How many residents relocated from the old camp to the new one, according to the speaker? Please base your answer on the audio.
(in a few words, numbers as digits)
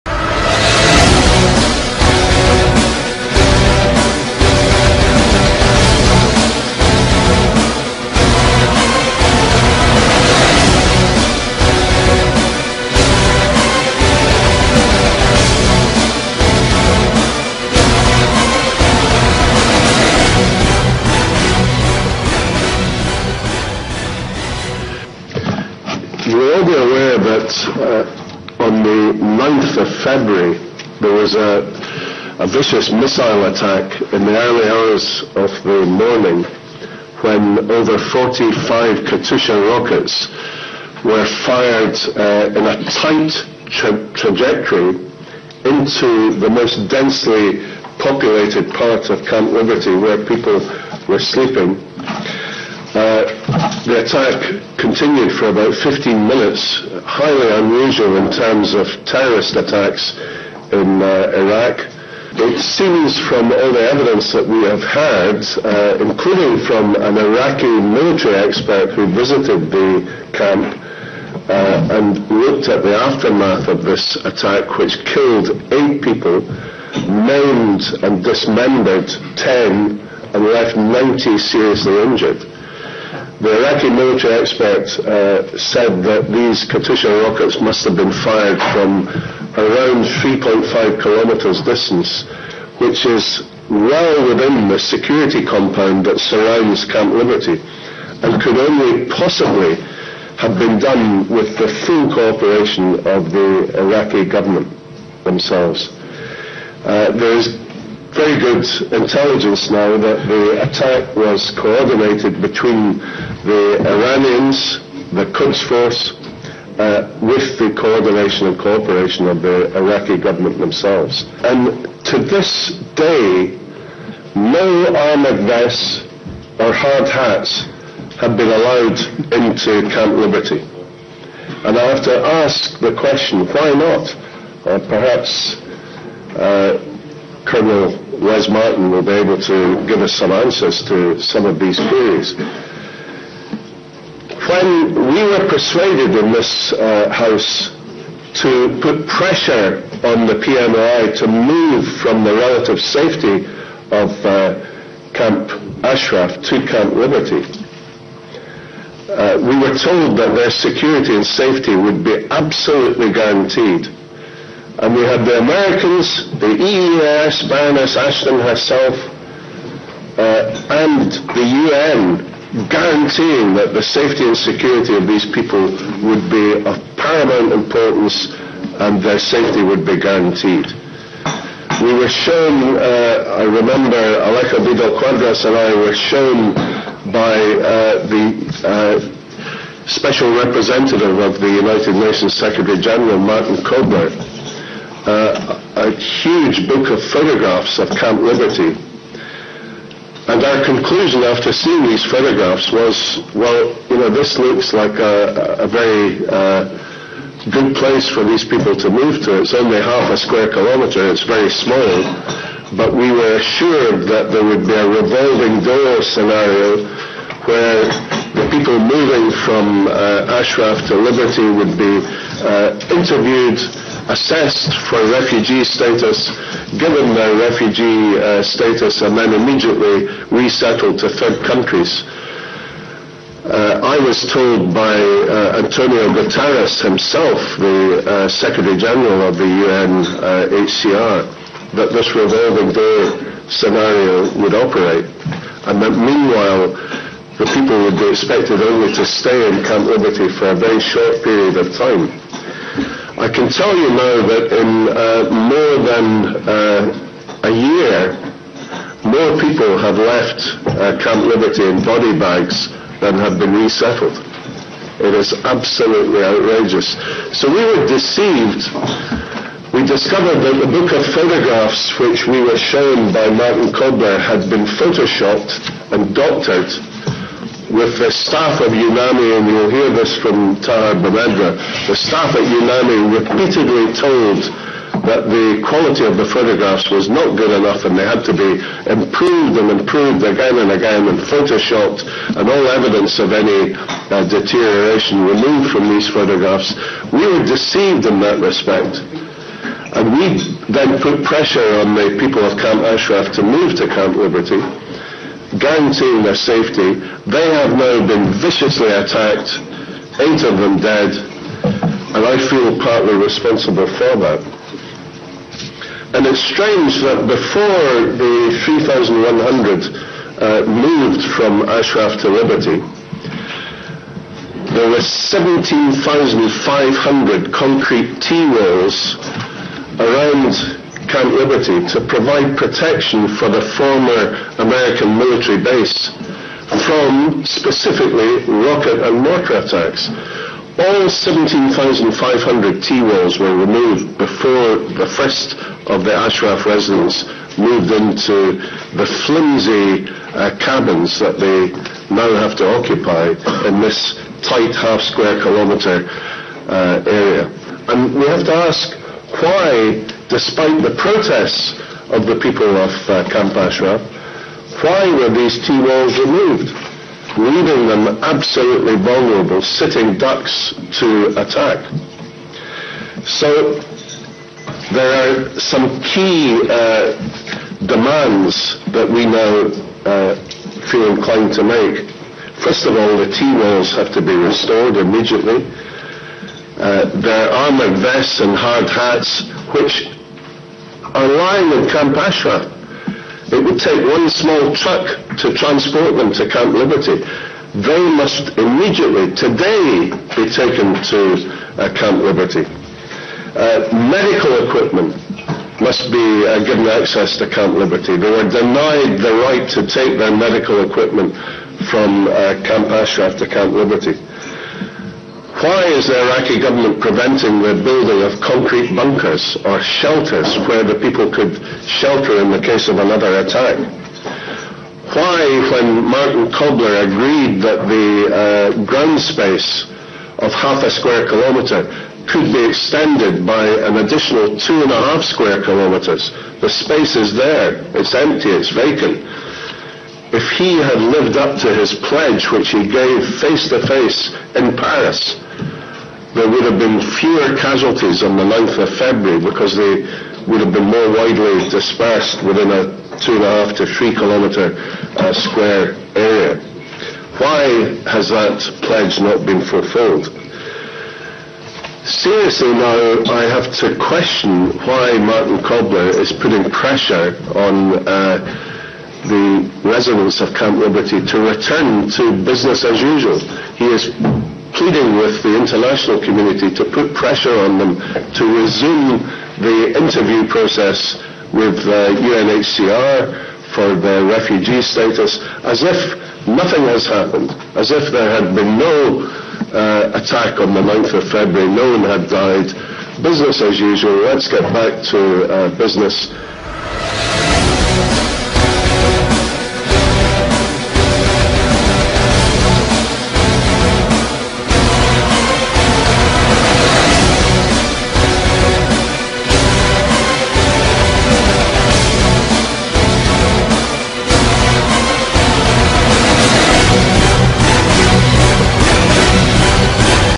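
3,100.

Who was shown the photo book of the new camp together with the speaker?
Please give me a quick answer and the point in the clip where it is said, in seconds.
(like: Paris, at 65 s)
Alejo Vidal Quadras, at 183 s.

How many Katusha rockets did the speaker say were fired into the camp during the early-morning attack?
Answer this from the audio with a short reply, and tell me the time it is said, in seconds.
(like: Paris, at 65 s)
over 45, at 37 s.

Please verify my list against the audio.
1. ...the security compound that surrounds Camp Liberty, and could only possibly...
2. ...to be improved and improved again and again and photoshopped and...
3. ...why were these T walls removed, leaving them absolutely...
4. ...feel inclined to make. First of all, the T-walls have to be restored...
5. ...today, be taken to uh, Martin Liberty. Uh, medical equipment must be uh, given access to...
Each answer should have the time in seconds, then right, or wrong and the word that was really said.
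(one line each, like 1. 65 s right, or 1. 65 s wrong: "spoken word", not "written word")
1. 94 s right
2. 288 s right
3. 364 s right
4. 380 s right
5. 399 s wrong: "Camp", not "Martin".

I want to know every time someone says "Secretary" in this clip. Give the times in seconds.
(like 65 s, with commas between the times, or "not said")
192 s, 238 s.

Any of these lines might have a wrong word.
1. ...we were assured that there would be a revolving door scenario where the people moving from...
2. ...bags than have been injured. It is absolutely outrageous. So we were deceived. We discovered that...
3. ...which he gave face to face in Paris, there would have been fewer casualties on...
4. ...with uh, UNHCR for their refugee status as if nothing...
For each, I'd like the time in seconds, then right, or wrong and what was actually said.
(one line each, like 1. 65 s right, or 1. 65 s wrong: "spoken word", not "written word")
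1. 212 s right
2. 262 s wrong: "resettled", not "injured"
3. 442 s right
4. 481 s right.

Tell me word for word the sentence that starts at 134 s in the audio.
Or perhaps uh, Colonel Wes Martin will be able to give us some answers to some of these queries.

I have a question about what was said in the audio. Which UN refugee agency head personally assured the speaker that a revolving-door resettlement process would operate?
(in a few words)
Antonio Guterres.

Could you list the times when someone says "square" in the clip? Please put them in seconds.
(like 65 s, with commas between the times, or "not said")
210 s, 355 s, 430 s, 435 s, 455 s.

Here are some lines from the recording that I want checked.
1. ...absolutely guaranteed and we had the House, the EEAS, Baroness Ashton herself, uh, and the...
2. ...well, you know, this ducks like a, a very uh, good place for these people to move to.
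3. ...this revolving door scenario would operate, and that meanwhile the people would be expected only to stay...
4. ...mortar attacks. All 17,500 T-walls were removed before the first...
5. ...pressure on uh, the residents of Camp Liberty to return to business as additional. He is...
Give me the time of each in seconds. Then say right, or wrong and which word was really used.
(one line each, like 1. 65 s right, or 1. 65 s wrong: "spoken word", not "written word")
1. 162 s wrong: "Americans", not "House"
2. 203 s wrong: "looks", not "ducks"
3. 241 s right
4. 339 s right
5. 466 s wrong: "usual", not "additional".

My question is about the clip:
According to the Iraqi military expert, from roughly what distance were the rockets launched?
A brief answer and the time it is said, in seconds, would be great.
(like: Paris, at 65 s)
3.5 kilometers, at 90 s.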